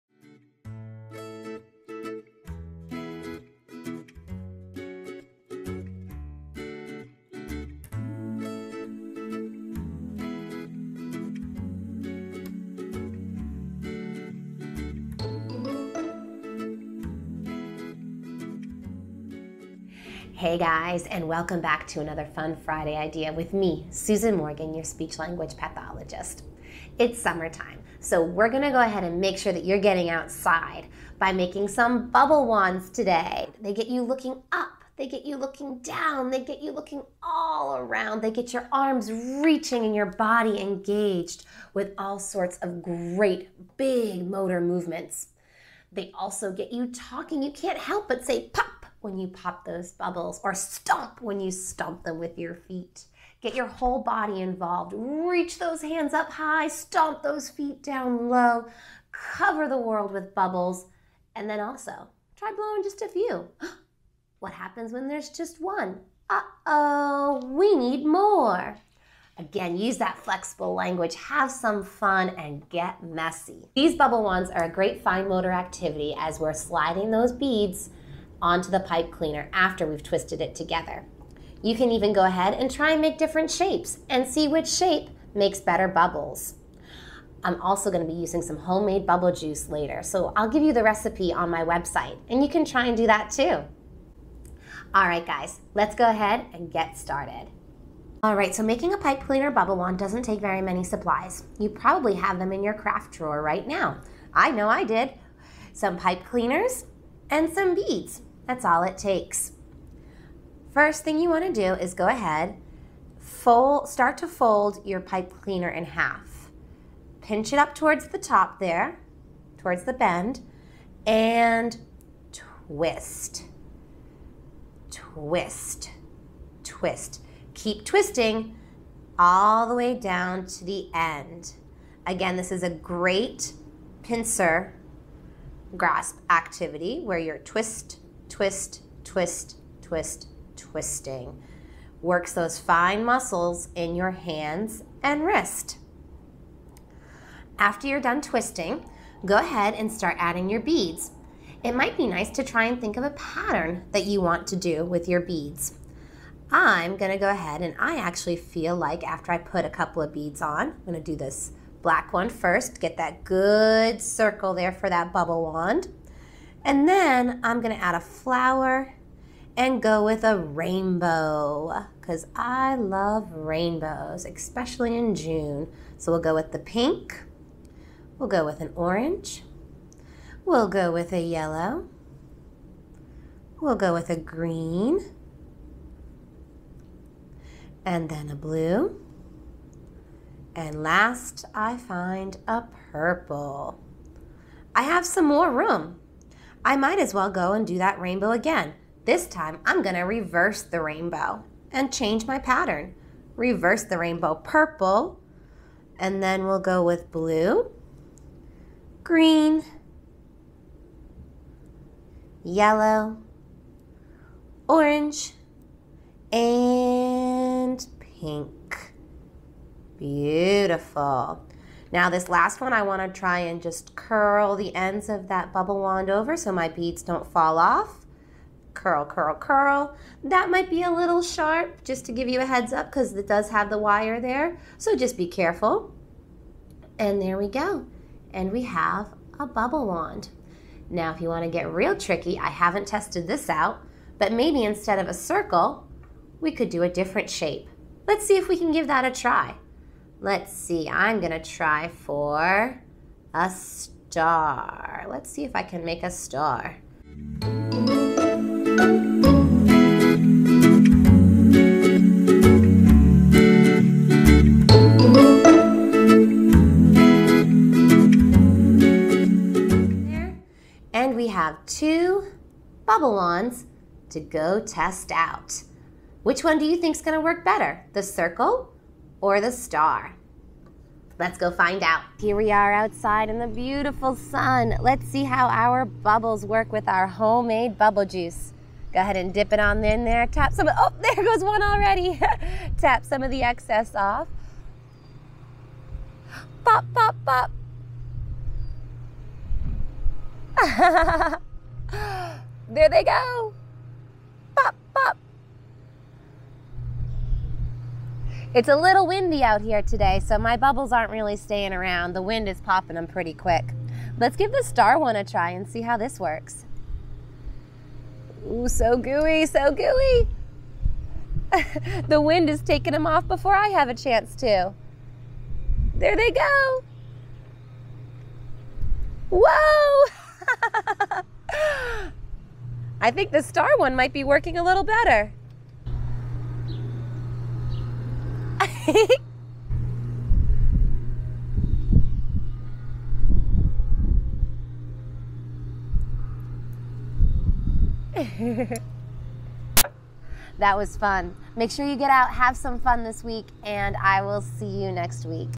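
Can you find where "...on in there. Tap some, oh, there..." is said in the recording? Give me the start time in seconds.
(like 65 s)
289 s.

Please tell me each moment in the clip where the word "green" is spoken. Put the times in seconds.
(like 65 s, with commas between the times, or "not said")
184 s, 209 s.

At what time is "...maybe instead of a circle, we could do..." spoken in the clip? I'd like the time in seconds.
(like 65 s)
244 s.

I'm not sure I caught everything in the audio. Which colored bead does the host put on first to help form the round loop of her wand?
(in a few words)
black.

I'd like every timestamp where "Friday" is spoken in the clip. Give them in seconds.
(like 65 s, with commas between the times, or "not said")
22 s.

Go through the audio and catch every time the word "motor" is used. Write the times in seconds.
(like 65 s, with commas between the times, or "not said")
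44 s, 75 s.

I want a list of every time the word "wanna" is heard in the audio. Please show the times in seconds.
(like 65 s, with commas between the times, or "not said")
222 s, 241 s.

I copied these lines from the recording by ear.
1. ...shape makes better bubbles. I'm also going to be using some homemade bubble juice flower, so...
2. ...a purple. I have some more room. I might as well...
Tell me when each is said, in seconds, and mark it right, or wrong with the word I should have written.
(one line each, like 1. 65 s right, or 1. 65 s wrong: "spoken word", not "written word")
1. 84 s wrong: "later", not "flower"
2. 192 s right.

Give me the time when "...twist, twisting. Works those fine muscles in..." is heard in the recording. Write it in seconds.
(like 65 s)
139 s.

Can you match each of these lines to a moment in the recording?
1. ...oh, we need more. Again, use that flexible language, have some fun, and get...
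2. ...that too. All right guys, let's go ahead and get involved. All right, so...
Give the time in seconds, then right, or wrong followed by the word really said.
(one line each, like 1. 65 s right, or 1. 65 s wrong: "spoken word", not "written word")
1. 66 s right
2. 93 s wrong: "started", not "involved".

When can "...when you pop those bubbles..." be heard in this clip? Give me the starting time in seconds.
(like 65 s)
49 s.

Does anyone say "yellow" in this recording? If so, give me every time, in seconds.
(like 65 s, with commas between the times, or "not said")
181 s, 212 s.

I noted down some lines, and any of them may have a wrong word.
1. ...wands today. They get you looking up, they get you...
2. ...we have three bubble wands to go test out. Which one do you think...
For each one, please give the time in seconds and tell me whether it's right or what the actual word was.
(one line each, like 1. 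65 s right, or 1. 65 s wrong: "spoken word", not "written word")
1. 32 s right
2. 271 s wrong: "two", not "three".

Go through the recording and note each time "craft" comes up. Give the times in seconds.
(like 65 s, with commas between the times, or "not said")
102 s.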